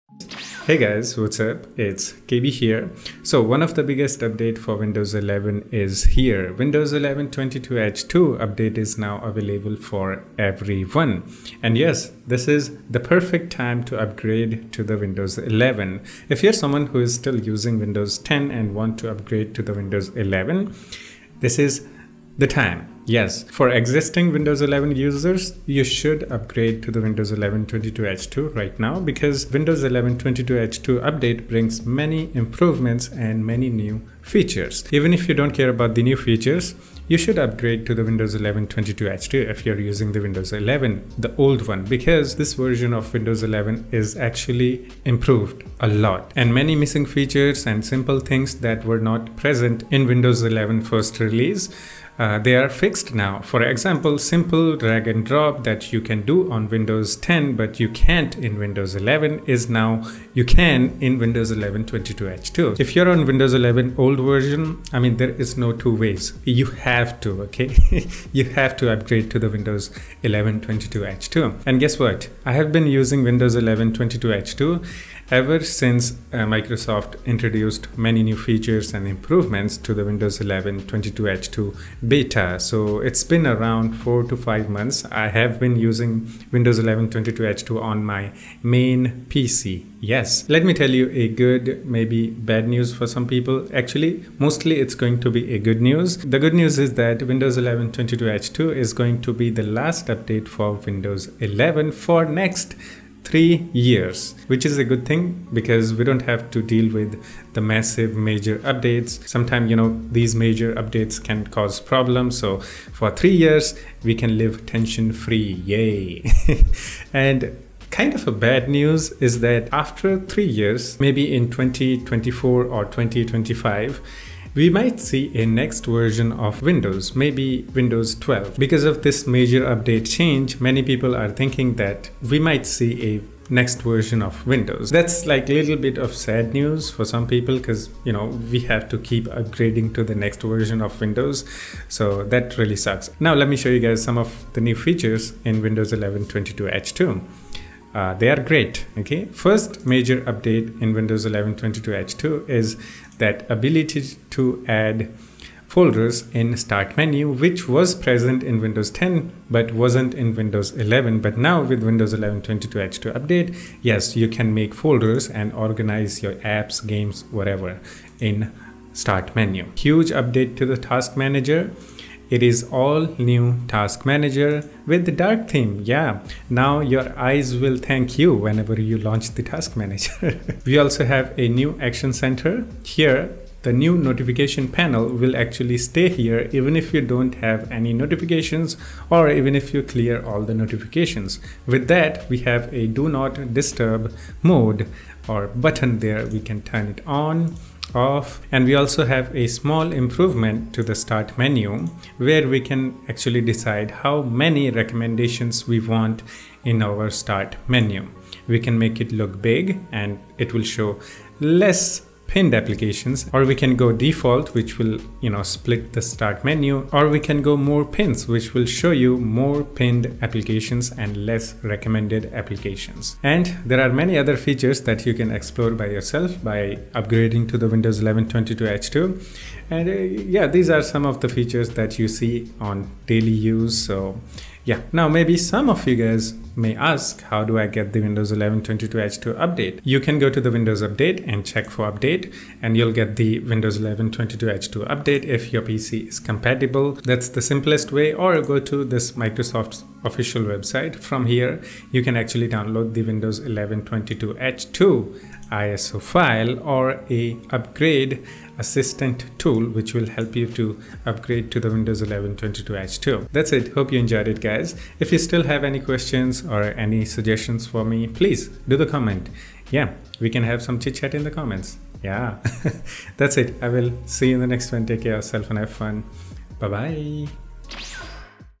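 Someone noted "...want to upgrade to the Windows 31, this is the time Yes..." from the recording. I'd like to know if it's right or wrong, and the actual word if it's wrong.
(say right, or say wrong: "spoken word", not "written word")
wrong: "11", not "31".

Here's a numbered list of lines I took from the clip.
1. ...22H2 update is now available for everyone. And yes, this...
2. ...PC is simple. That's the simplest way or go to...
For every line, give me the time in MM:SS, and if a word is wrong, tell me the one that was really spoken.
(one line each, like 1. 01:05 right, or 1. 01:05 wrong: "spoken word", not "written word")
1. 00:07 right
2. 04:05 wrong: "compatible", not "simple".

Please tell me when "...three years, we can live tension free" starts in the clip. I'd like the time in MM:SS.
01:53.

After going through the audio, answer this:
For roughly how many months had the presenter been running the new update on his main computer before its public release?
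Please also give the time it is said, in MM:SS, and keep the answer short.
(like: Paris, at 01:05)
4 to 5 months, at 01:23.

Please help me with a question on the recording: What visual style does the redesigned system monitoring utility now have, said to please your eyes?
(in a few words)
dark theme.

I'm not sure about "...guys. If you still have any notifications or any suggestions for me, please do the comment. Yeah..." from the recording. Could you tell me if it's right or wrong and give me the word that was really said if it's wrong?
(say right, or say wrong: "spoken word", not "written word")
wrong: "questions", not "notifications".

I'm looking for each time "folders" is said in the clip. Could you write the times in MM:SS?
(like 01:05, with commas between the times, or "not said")
02:35, 02:44.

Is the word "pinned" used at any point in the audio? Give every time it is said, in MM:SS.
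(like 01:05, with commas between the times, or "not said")
03:32, 03:39.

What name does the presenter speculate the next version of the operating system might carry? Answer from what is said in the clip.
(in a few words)
Windows 12.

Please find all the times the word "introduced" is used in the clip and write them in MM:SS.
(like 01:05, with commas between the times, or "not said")
01:17.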